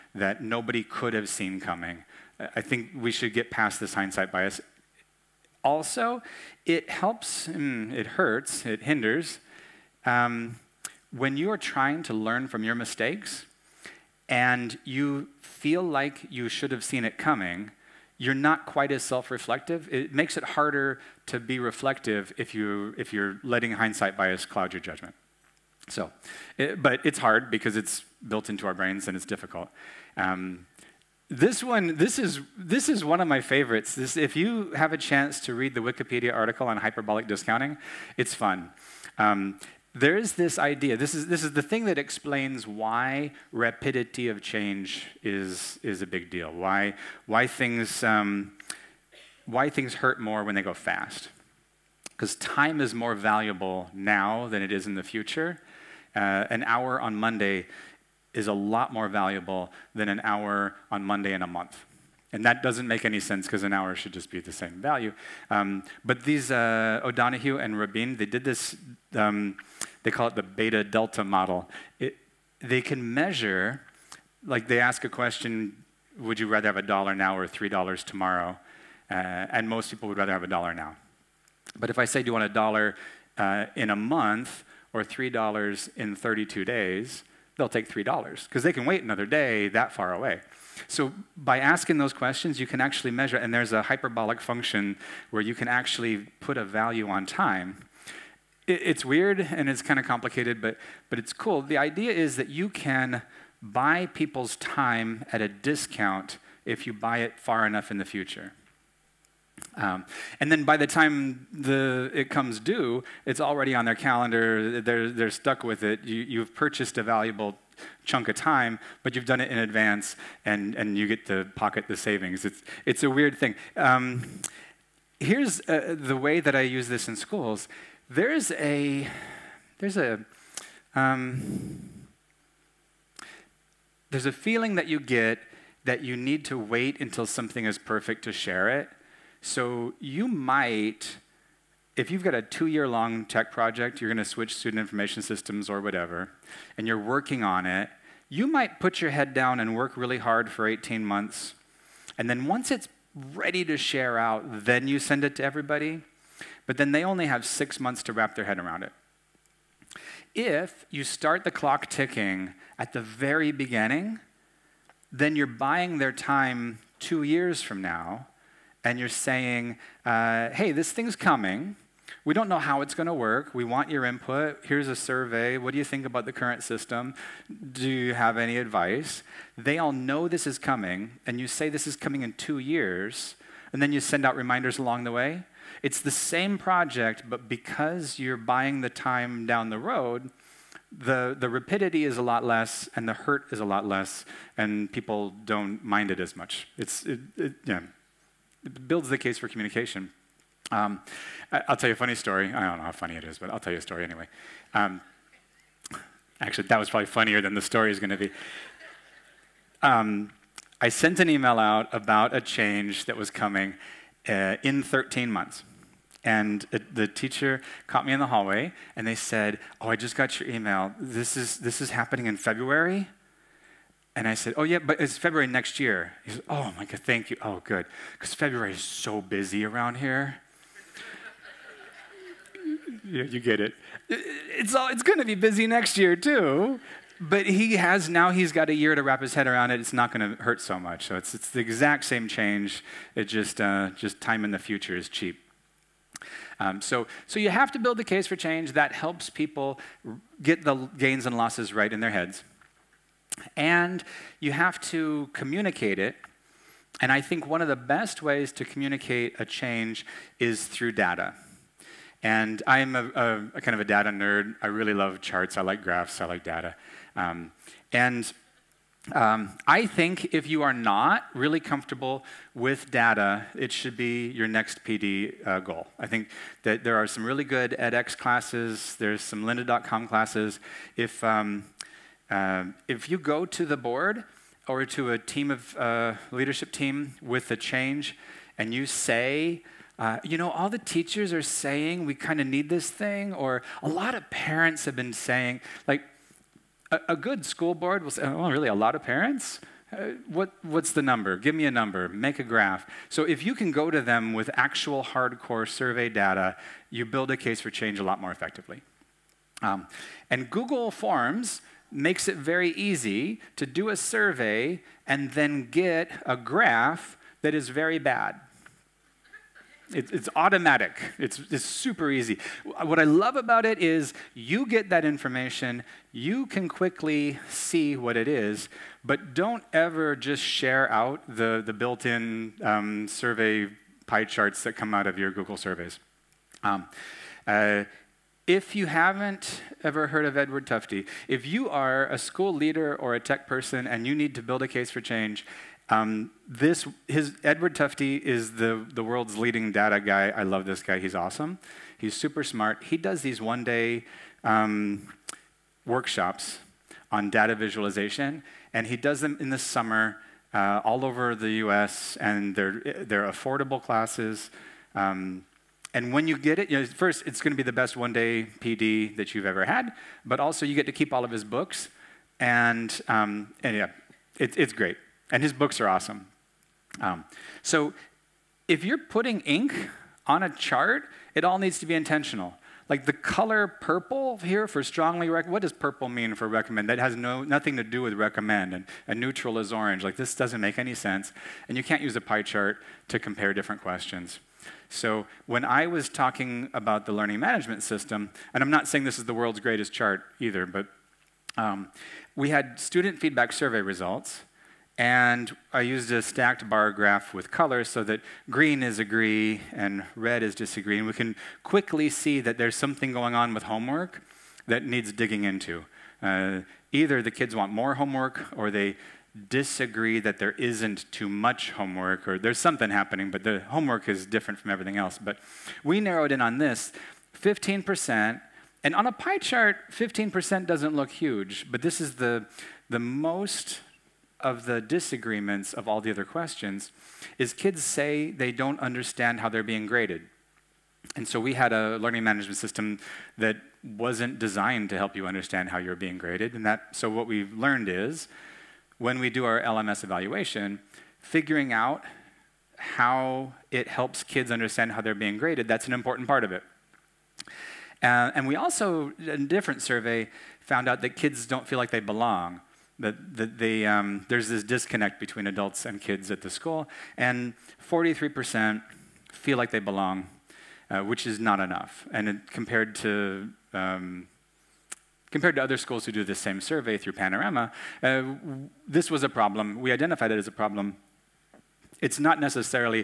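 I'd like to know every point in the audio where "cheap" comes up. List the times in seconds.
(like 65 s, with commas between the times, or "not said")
245 s.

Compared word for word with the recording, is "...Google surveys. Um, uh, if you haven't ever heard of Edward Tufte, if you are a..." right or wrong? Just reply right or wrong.
right.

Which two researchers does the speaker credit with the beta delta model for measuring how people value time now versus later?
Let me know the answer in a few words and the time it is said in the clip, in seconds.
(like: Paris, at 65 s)
O'Donoghue and Rabin, at 67 s.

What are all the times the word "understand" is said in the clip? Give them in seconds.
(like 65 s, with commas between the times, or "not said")
438 s, 445 s, 454 s.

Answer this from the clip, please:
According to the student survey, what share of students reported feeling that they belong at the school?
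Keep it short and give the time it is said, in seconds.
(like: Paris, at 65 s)
43%, at 467 s.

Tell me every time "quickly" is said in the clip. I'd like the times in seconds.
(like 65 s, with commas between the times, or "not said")
326 s, 411 s.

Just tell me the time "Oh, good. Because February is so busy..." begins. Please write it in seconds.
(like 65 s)
227 s.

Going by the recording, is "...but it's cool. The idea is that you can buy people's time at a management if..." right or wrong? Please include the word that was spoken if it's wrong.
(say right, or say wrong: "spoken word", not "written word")
wrong: "discount", not "management".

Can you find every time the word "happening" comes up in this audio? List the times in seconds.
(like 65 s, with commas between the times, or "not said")
221 s, 422 s.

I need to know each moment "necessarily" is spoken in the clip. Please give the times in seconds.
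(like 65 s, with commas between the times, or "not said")
482 s.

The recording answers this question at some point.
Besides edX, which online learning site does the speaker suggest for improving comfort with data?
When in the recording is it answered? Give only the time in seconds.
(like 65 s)
279 s.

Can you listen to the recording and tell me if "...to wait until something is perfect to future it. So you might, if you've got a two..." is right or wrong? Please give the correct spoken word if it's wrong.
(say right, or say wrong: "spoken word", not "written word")
wrong: "share", not "future".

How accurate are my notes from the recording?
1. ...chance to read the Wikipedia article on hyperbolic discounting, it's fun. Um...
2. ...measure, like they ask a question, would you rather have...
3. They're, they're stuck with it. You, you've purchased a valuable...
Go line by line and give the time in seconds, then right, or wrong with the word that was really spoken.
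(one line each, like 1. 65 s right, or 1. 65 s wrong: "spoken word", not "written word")
1. 34 s right
2. 73 s right
3. 114 s right.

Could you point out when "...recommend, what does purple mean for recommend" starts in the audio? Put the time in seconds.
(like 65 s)
385 s.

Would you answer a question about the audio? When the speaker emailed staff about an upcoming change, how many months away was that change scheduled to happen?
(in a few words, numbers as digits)
13 months.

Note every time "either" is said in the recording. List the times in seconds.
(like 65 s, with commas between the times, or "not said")
400 s, 416 s.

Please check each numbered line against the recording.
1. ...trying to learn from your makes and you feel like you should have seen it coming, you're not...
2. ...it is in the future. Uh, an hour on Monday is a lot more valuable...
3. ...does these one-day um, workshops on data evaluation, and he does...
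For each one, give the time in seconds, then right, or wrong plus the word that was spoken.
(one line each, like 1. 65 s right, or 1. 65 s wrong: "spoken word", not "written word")
1. 11 s wrong: "mistakes", not "makes"
2. 54 s right
3. 352 s wrong: "visualization", not "evaluation".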